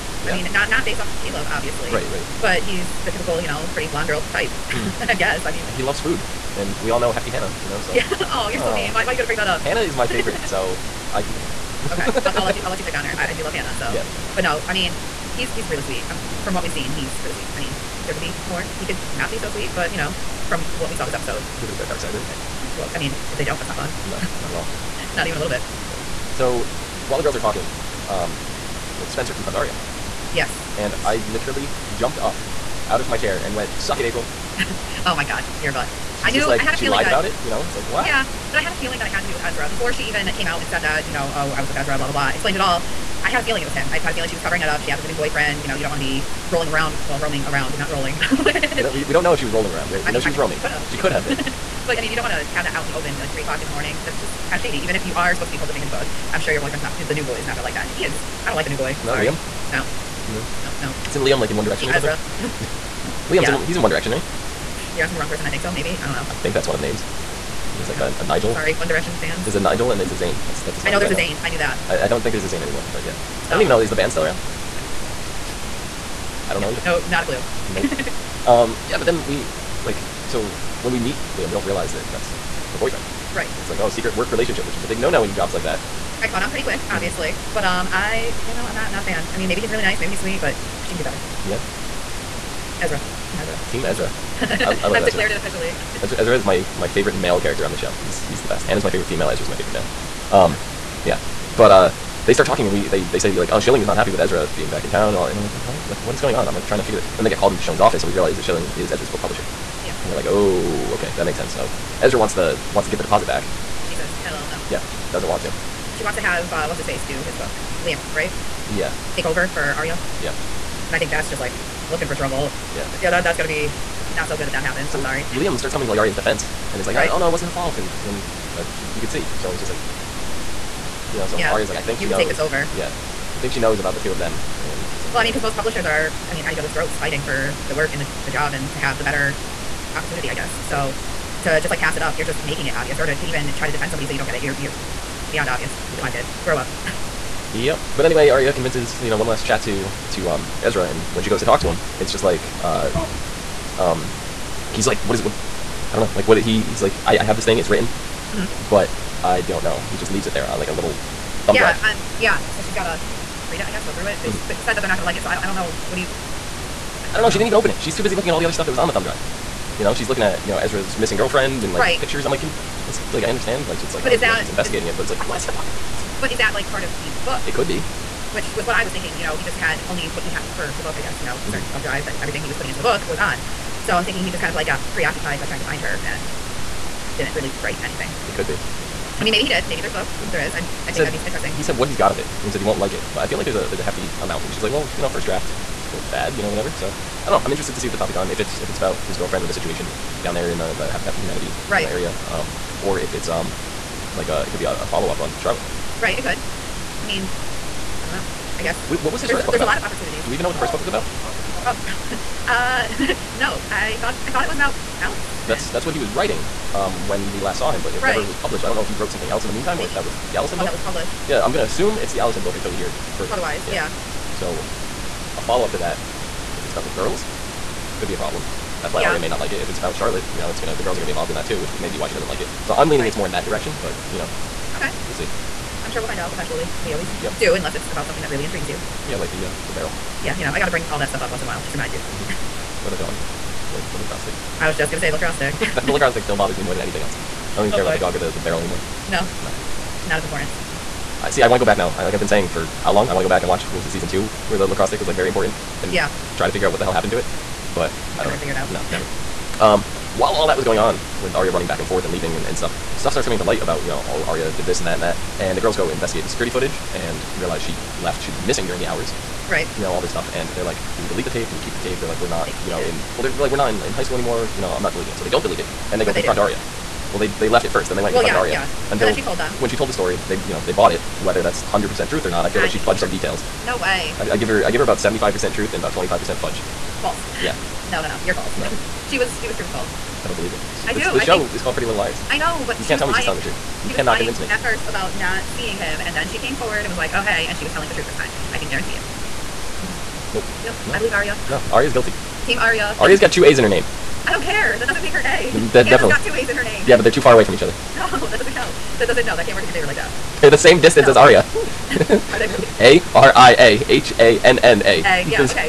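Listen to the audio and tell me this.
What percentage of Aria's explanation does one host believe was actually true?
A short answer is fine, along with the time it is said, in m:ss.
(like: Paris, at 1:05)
75%, at 4:44.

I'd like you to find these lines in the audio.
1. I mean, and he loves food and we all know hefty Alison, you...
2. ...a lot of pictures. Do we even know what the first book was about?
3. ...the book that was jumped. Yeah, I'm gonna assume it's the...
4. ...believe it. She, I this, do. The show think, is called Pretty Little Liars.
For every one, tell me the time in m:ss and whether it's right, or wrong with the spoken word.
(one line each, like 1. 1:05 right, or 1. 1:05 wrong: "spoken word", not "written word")
1. 0:05 wrong: "Hannah", not "Alison"
2. 3:29 wrong: "opportunities", not "pictures"
3. 3:40 wrong: "published", not "jumped"
4. 4:50 right.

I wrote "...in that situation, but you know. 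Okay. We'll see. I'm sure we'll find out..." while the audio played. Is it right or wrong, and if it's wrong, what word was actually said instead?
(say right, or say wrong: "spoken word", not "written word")
wrong: "direction", not "situation".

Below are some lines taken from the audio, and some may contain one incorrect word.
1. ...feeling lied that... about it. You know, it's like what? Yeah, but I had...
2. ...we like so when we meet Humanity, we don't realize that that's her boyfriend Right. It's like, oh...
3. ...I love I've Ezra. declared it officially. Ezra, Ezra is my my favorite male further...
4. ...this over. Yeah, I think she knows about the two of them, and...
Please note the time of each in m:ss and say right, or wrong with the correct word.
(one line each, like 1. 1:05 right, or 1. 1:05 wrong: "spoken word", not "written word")
1. 0:36 right
2. 1:19 wrong: "Liam", not "Humanity"
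3. 1:34 wrong: "character", not "further"
4. 2:12 right.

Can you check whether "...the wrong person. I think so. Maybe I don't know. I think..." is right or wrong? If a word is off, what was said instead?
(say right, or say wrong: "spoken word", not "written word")
right.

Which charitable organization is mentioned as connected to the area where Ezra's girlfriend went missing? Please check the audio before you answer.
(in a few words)
Habitat for Humanity.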